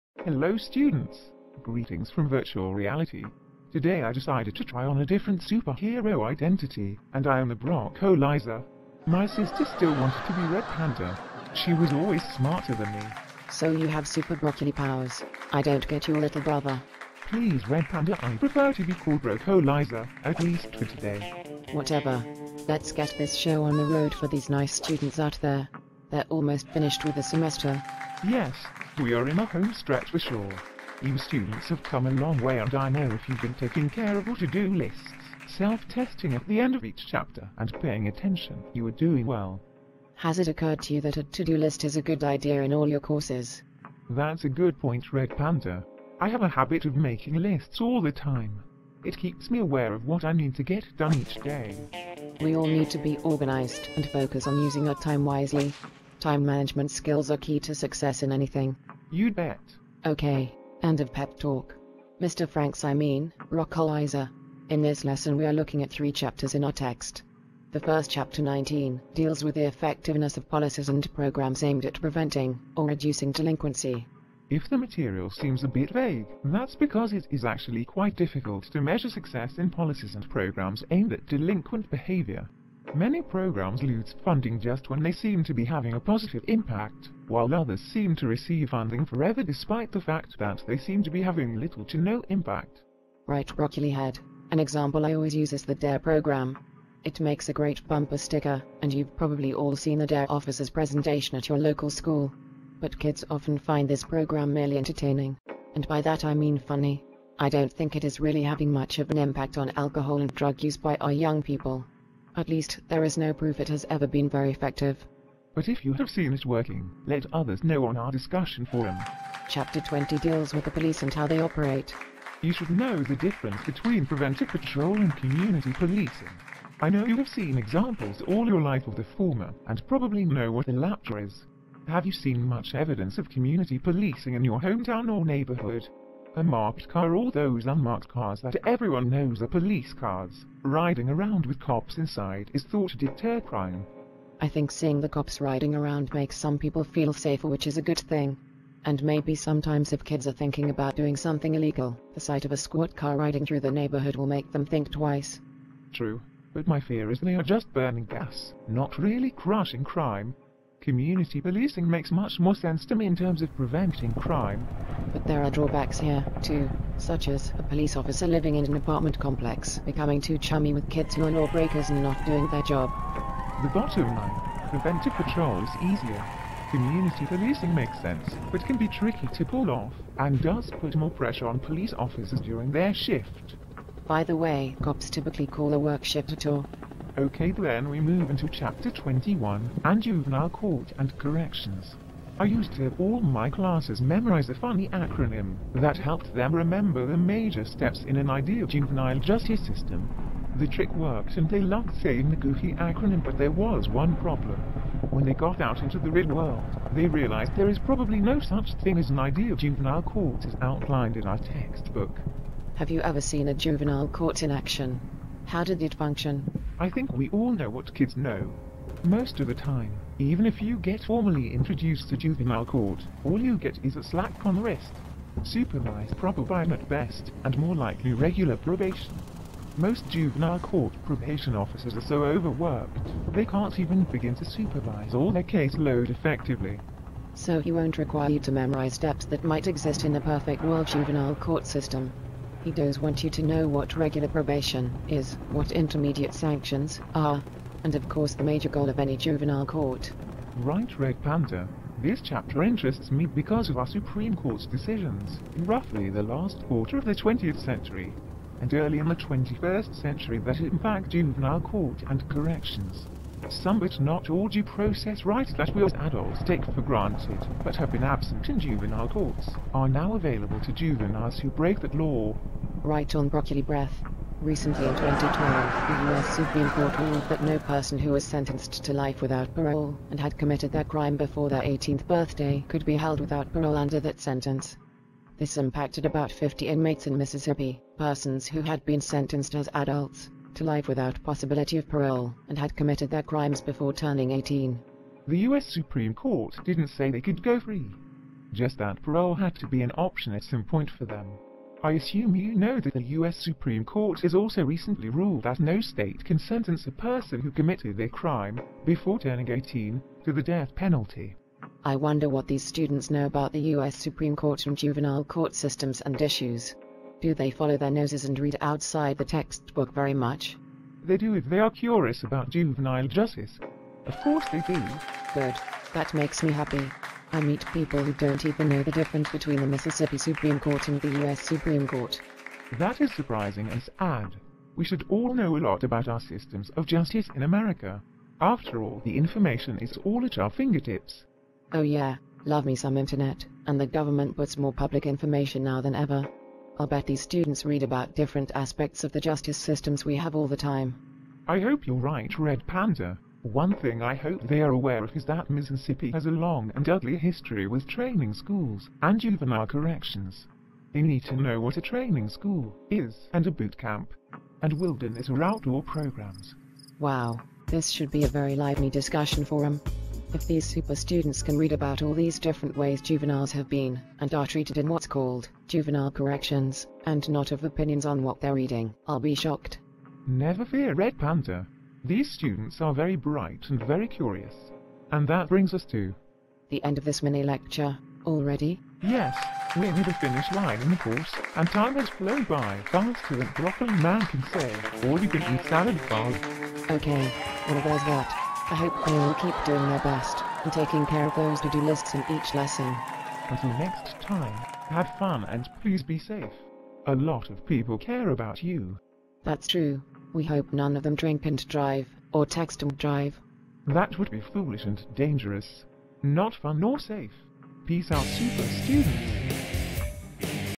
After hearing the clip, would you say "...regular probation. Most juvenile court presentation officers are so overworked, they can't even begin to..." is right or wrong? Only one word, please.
wrong.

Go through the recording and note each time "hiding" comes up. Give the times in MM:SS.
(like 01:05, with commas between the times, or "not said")
not said.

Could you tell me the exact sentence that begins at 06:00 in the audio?
They need to know what a training school is and a boot camp, and wilderness or outdoor programs.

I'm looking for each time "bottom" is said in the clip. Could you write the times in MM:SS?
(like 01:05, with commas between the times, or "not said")
02:53.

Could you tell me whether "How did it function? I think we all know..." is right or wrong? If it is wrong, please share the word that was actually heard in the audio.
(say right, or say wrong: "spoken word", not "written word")
right.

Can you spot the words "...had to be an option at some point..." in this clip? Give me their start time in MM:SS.
04:59.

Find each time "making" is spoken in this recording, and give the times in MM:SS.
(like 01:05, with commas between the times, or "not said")
00:46.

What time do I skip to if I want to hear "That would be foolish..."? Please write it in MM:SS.
06:53.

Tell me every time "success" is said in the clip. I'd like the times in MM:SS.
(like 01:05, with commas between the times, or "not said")
00:57, 01:19.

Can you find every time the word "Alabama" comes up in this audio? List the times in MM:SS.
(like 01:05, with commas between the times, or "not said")
not said.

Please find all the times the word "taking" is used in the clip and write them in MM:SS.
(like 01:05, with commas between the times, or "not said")
00:33, 06:40.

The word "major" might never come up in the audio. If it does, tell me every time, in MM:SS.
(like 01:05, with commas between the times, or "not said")
03:17, 04:08.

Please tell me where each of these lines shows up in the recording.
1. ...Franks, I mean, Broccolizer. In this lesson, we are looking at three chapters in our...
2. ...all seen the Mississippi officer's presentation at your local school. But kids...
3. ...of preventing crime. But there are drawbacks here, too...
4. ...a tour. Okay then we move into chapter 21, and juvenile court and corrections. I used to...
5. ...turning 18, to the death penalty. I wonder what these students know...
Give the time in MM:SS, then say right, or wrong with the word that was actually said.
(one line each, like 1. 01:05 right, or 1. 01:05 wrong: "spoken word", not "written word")
1. 01:02 right
2. 01:39 wrong: "DARE", not "Mississippi"
3. 02:43 right
4. 03:06 right
5. 05:09 right.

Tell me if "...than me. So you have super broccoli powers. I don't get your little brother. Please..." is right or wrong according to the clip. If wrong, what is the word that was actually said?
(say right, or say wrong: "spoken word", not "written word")
right.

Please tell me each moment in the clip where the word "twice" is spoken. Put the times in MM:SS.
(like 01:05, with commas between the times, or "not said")
02:34.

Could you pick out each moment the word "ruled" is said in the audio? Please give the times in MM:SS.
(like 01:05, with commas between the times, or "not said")
04:36, 05:05.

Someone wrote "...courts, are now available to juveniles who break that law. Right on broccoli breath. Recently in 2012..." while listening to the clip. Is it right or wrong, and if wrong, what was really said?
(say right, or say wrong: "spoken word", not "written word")
right.